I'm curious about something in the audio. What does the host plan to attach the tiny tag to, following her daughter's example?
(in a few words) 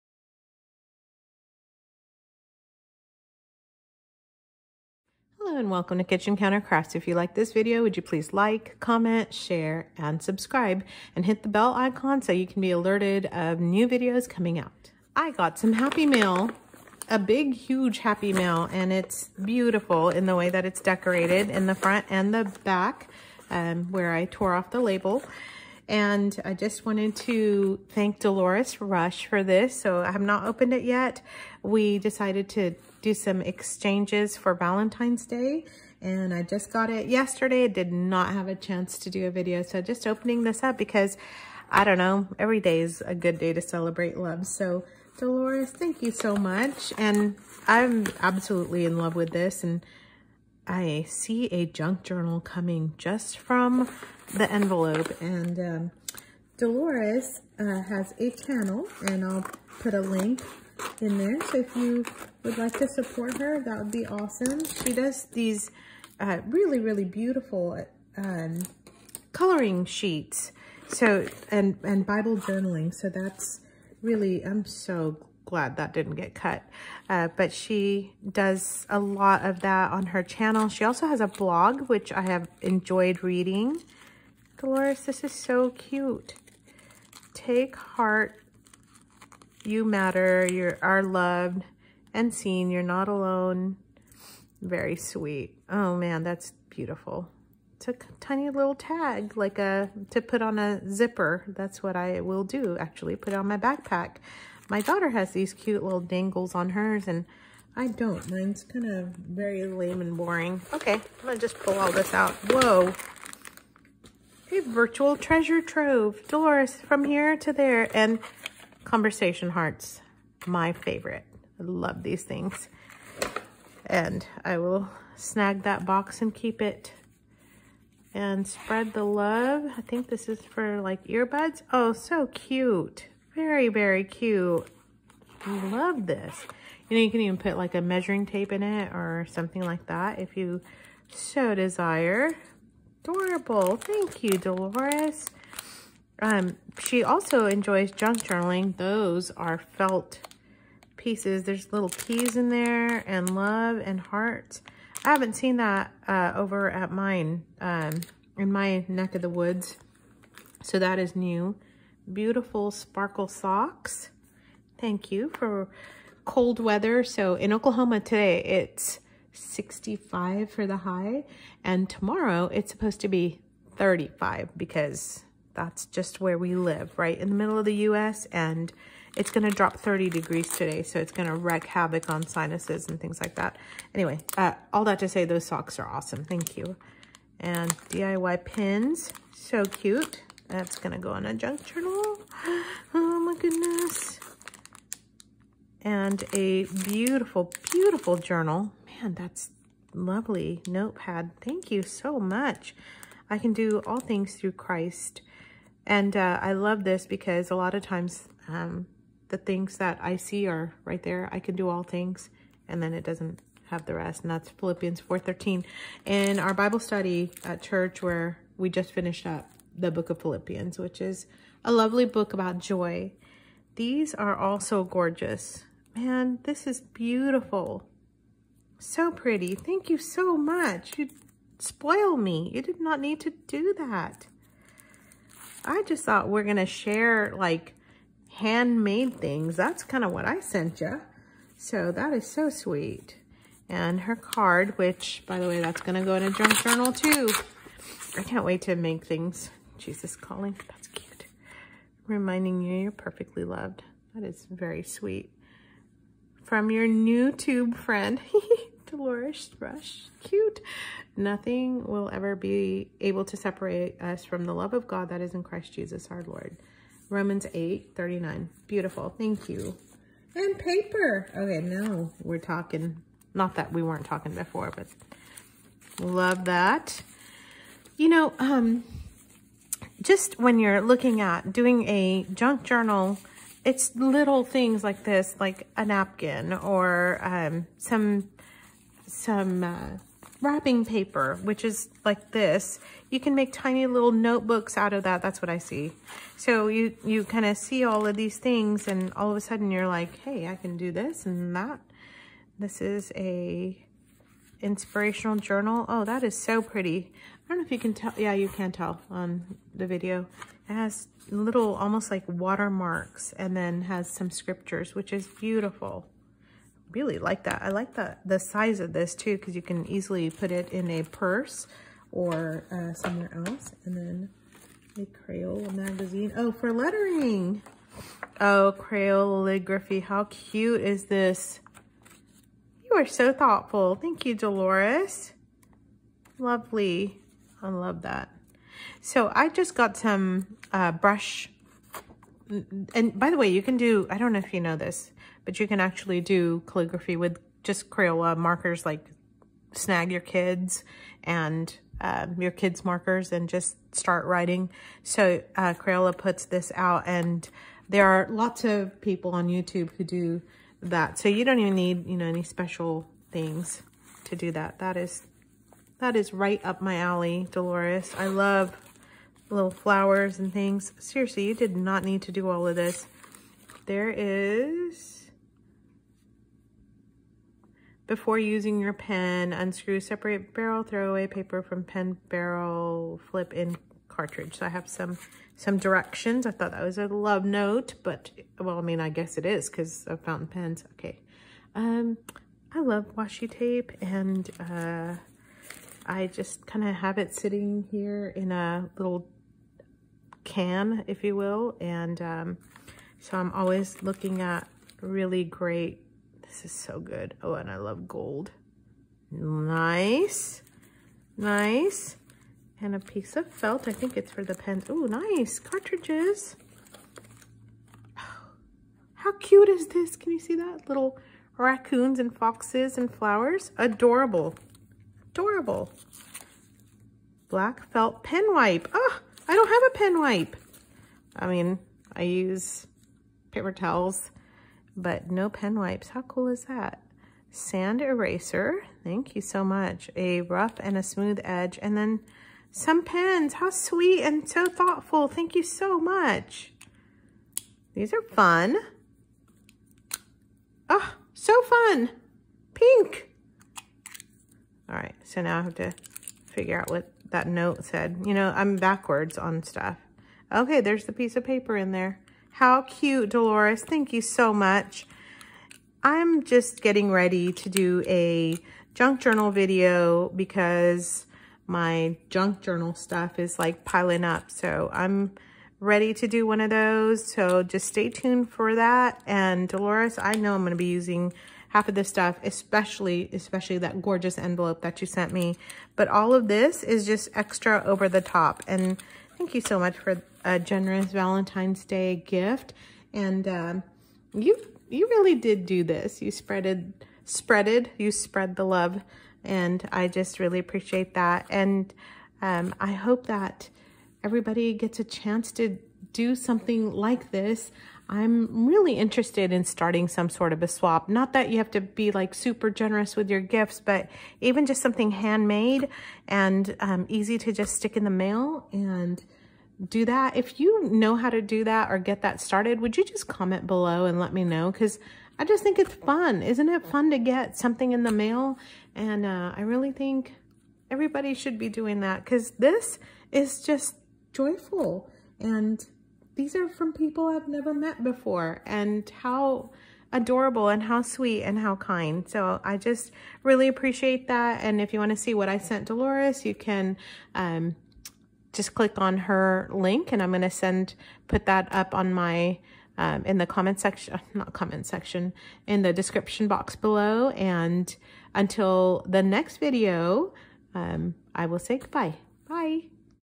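Backpack.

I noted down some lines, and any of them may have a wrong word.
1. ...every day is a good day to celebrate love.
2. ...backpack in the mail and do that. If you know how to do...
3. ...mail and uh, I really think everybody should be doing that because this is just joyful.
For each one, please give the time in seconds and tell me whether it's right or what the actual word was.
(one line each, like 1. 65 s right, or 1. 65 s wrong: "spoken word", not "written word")
1. 42 s right
2. 517 s wrong: "stick", not "backpack"
3. 528 s right.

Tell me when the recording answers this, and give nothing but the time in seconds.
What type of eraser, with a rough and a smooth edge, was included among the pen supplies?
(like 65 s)
437 s.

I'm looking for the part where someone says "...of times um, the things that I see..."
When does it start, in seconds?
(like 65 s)
207 s.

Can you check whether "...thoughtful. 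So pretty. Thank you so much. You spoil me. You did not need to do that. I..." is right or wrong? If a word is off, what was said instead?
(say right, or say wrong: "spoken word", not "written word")
wrong: "beautiful", not "thoughtful".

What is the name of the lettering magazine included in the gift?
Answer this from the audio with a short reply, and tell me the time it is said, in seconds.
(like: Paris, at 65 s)
Crayoligraphy, at 328 s.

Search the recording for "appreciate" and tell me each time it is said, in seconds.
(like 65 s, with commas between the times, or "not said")
500 s, 543 s.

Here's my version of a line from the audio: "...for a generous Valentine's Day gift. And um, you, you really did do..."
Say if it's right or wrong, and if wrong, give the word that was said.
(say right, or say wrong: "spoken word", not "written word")
right.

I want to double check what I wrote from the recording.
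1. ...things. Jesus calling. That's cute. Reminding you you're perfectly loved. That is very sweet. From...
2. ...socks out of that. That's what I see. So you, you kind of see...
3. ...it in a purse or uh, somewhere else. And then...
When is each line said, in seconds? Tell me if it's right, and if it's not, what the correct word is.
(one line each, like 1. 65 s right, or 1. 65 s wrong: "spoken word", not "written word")
1. 249 s right
2. 294 s wrong: "notebooks", not "socks"
3. 320 s right.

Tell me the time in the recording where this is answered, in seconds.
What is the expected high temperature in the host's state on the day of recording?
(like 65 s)
169 s.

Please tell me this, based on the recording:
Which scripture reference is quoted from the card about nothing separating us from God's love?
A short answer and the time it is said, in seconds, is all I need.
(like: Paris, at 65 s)
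Romans 8:39, at 267 s.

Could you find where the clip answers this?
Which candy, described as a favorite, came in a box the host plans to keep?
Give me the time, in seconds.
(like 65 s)
118 s.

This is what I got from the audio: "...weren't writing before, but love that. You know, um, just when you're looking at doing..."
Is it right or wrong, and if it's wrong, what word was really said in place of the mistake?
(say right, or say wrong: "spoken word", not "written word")
wrong: "talking", not "writing".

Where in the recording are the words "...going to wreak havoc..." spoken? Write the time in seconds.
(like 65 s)
181 s.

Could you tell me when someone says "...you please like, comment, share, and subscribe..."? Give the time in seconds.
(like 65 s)
7 s.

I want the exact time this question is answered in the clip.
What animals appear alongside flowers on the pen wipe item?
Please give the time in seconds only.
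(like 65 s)
421 s.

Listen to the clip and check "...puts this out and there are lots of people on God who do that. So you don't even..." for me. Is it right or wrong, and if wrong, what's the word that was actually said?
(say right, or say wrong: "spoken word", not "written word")
wrong: "YouTube", not "God".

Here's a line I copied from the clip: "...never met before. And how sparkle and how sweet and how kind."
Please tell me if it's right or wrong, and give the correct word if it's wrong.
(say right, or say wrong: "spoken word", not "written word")
wrong: "adorable", not "sparkle".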